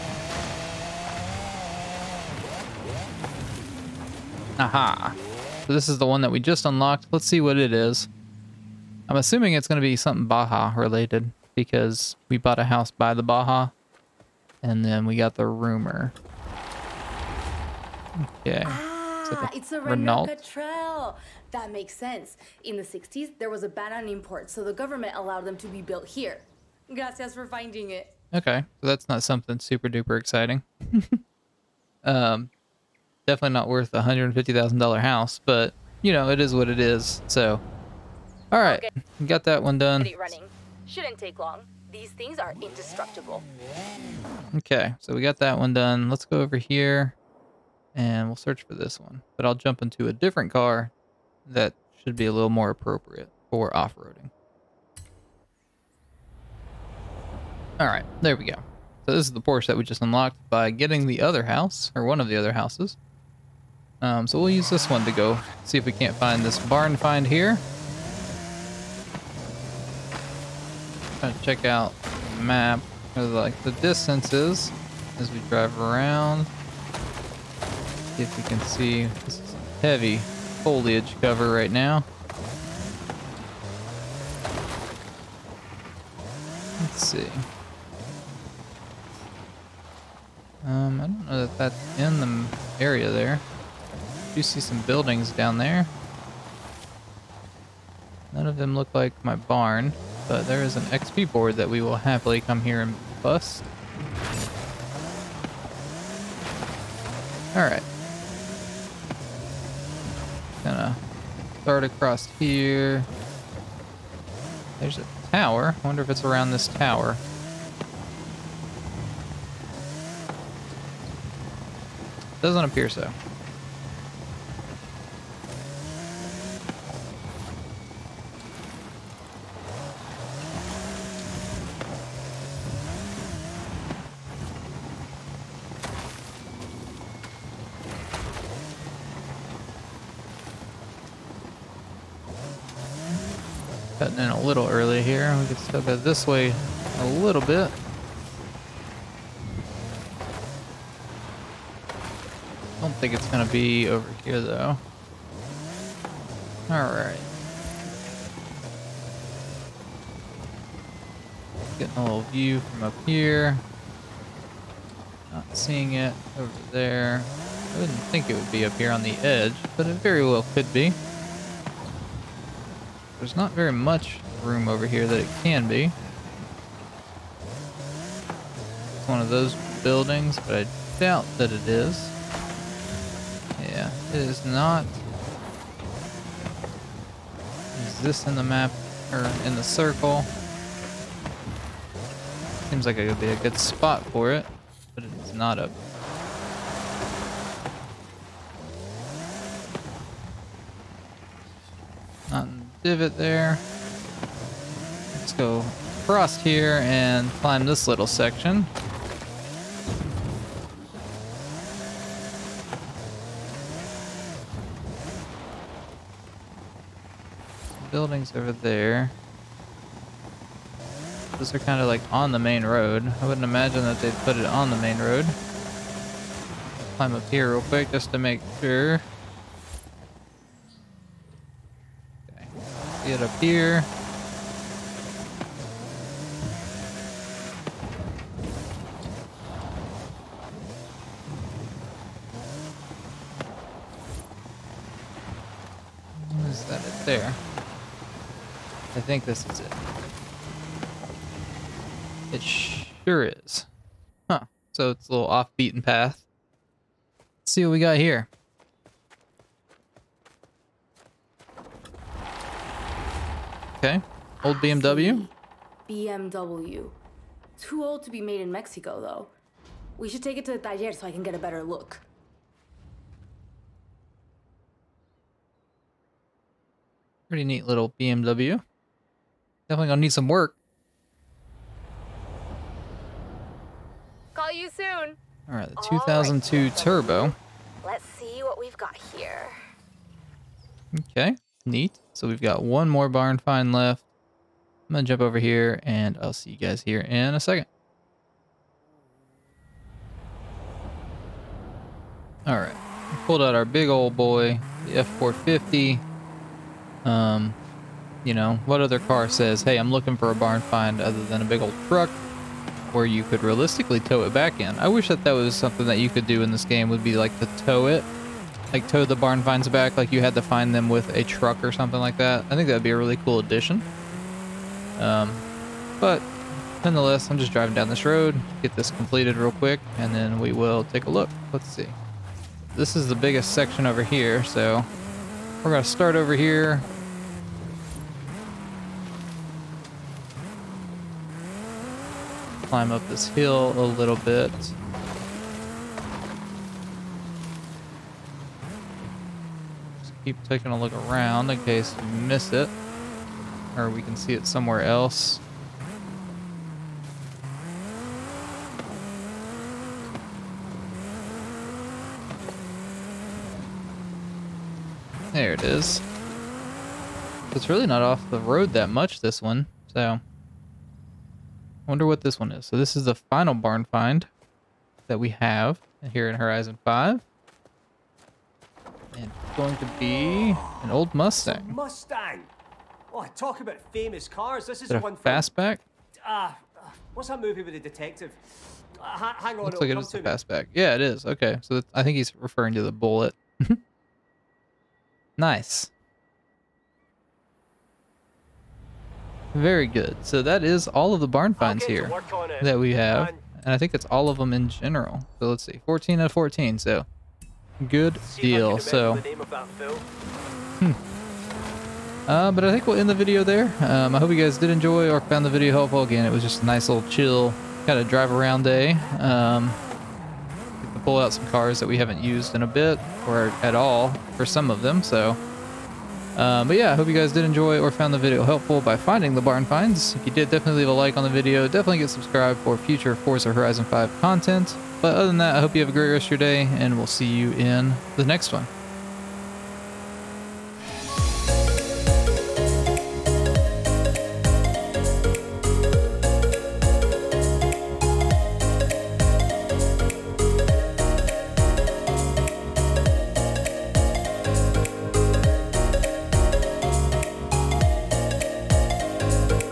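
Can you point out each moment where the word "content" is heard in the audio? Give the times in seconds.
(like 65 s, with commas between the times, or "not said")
434 s.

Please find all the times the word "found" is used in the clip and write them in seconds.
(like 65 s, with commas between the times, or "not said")
415 s, 427 s.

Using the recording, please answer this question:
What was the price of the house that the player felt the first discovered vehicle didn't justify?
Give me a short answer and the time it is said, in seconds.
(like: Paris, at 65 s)
$150,000, at 34 s.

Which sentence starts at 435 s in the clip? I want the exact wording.
But other than that, I hope you have a great rest of your day, and we'll see you in the next one.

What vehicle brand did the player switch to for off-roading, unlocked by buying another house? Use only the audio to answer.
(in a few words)
Porsche.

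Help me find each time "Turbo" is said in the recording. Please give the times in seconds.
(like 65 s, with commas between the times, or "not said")
286 s.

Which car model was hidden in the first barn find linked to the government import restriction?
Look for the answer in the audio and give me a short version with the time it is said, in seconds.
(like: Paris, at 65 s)
Renault Trail, at 19 s.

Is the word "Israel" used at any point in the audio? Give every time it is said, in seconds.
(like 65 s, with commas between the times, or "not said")
not said.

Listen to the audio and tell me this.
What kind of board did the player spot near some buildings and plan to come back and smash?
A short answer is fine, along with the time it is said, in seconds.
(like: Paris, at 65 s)
XP board, at 100 s.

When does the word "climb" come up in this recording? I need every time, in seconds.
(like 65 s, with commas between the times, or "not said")
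207 s, 226 s, 342 s.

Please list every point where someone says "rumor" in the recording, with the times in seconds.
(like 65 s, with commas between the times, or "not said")
15 s.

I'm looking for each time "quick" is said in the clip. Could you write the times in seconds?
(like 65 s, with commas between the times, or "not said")
227 s, 329 s.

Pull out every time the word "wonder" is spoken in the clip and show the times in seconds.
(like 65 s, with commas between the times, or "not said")
115 s, 371 s.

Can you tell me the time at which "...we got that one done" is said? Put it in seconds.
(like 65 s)
45 s.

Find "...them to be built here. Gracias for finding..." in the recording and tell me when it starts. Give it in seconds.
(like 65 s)
25 s.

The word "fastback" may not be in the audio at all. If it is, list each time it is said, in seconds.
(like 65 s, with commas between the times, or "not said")
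385 s, 390 s.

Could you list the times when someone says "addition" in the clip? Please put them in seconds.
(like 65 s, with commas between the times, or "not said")
323 s.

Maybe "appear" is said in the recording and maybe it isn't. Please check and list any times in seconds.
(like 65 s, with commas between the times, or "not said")
122 s.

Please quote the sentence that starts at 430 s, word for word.
If you did, definitely leave a like on the video.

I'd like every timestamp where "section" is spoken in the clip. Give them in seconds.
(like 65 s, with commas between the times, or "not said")
208 s, 333 s.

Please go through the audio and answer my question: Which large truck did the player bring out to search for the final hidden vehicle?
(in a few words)
F450.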